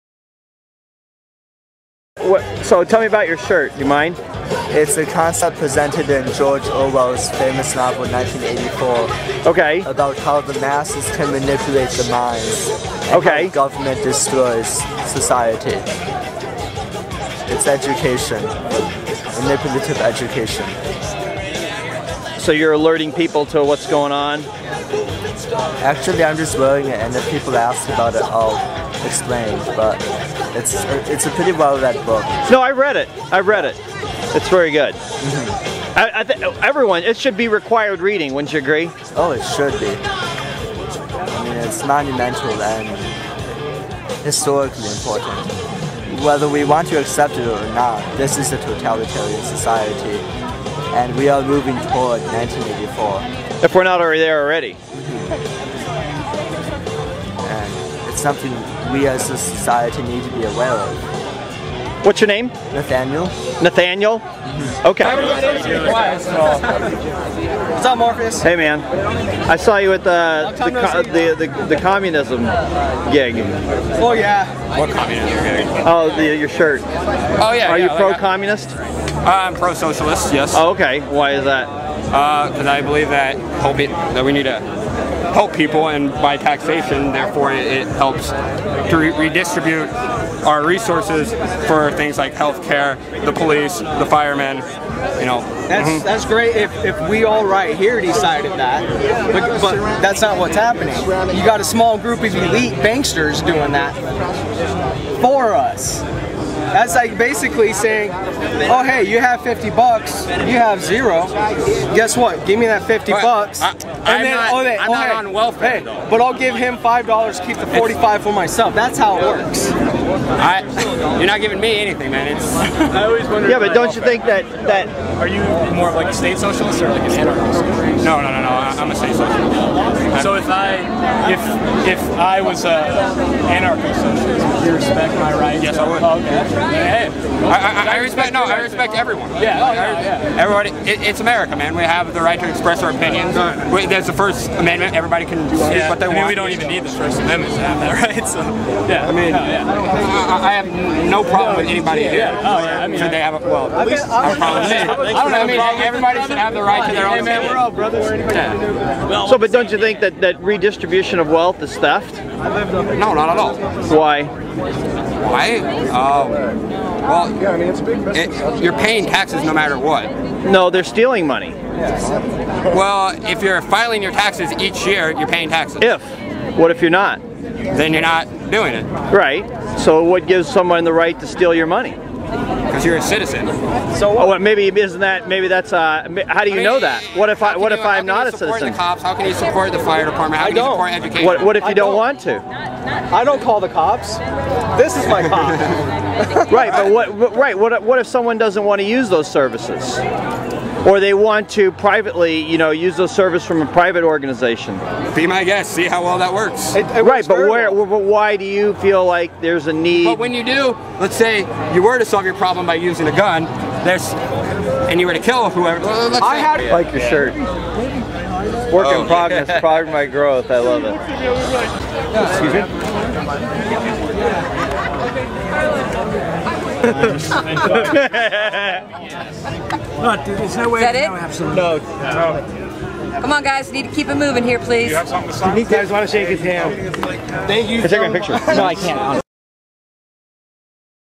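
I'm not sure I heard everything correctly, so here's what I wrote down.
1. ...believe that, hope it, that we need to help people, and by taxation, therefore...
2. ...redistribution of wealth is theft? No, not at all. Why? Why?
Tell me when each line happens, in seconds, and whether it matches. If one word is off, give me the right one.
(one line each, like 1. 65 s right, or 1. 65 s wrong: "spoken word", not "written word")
1. 82 s right
2. 160 s right.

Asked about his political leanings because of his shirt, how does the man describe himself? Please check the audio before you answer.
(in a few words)
pro socialist.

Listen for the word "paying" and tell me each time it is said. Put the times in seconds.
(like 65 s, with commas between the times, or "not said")
168 s, 175 s.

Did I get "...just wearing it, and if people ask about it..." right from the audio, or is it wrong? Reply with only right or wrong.
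right.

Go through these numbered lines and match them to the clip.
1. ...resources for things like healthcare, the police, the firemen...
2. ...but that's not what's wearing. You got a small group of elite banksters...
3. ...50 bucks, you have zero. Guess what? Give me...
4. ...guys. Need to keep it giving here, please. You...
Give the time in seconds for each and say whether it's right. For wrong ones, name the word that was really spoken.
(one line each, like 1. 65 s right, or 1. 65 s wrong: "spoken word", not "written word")
1. 90 s right
2. 99 s wrong: "happening", not "wearing"
3. 109 s right
4. 233 s wrong: "moving", not "giving".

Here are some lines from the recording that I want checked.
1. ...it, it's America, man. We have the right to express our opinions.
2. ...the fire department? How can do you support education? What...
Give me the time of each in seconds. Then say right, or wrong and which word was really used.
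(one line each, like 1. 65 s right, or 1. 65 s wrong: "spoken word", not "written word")
1. 140 s right
2. 189 s right.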